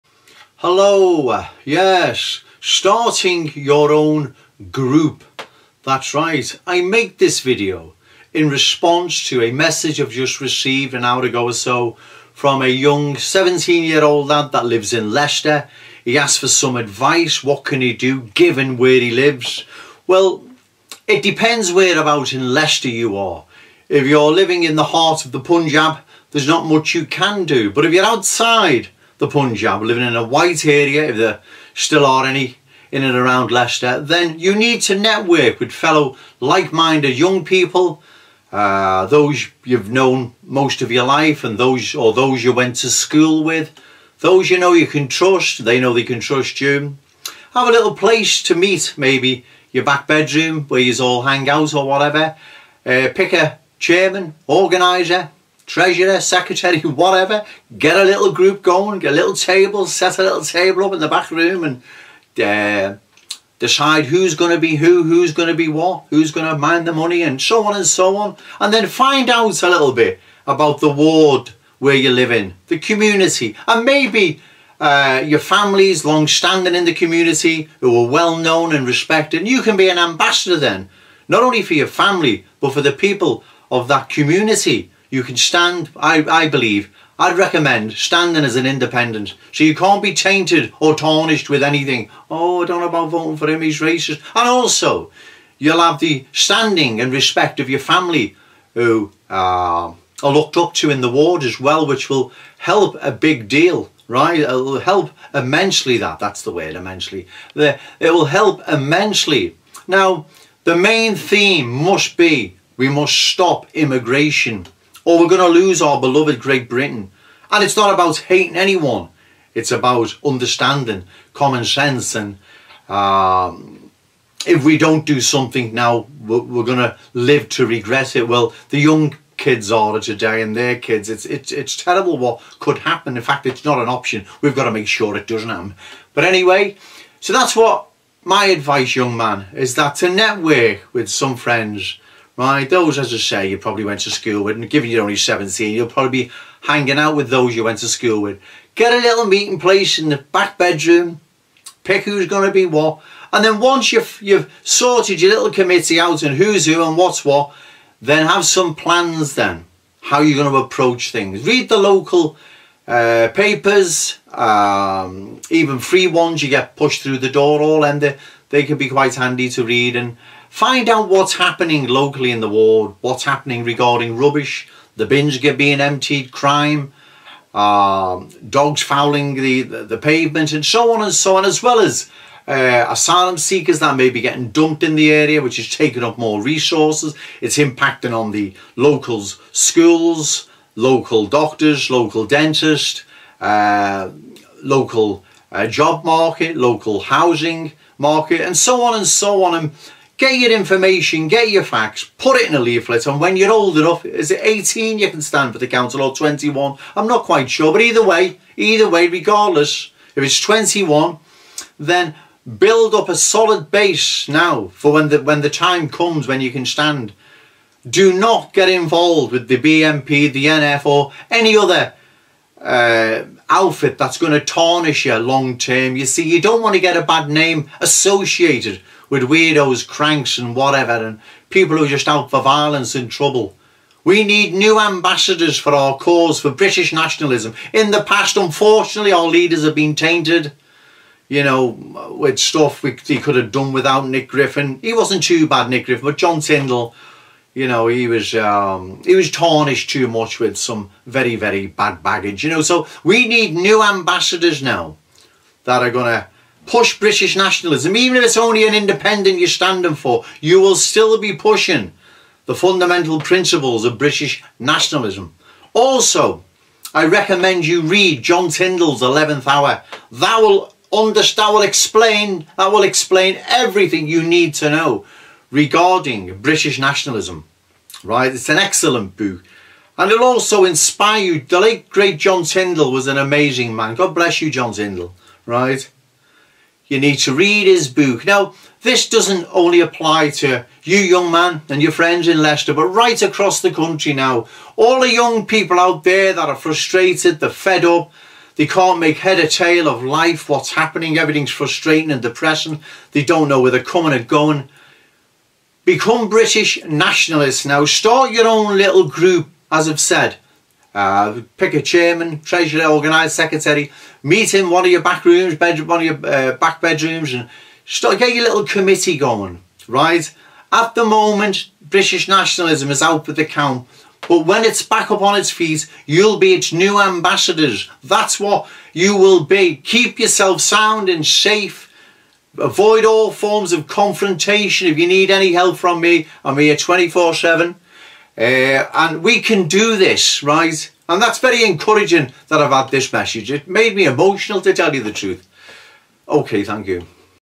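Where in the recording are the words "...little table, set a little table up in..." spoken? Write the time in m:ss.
0:59.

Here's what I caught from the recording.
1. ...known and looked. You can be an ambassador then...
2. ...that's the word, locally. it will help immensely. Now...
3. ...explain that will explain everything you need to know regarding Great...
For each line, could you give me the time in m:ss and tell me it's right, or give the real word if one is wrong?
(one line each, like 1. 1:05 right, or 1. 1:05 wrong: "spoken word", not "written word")
1. 1:18 wrong: "respected", not "looked"
2. 1:46 wrong: "immensely", not "locally"
3. 4:31 wrong: "British", not "Great".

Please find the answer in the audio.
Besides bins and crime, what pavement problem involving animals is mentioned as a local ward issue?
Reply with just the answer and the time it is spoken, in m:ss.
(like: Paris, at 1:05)
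Dogs fouling, at 2:58.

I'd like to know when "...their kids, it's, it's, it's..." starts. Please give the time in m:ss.
2:10.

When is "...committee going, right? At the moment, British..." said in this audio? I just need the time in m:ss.
5:18.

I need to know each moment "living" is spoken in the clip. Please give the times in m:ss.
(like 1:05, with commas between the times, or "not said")
0:24, 0:29.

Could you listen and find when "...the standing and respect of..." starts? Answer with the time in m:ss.
1:35.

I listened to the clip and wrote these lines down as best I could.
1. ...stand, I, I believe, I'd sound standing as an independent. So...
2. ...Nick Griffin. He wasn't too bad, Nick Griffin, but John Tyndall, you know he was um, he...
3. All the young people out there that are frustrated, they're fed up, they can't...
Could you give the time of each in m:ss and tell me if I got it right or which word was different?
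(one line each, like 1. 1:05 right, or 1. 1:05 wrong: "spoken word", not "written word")
1. 1:25 wrong: "recommend", not "sound"
2. 4:04 right
3. 4:54 right.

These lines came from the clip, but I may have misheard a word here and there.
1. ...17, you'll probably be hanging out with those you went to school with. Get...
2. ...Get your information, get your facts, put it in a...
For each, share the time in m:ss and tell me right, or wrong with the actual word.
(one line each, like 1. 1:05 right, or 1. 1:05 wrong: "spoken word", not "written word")
1. 2:25 right
2. 3:20 right.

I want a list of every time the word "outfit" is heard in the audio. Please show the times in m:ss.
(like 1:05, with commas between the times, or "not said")
3:43.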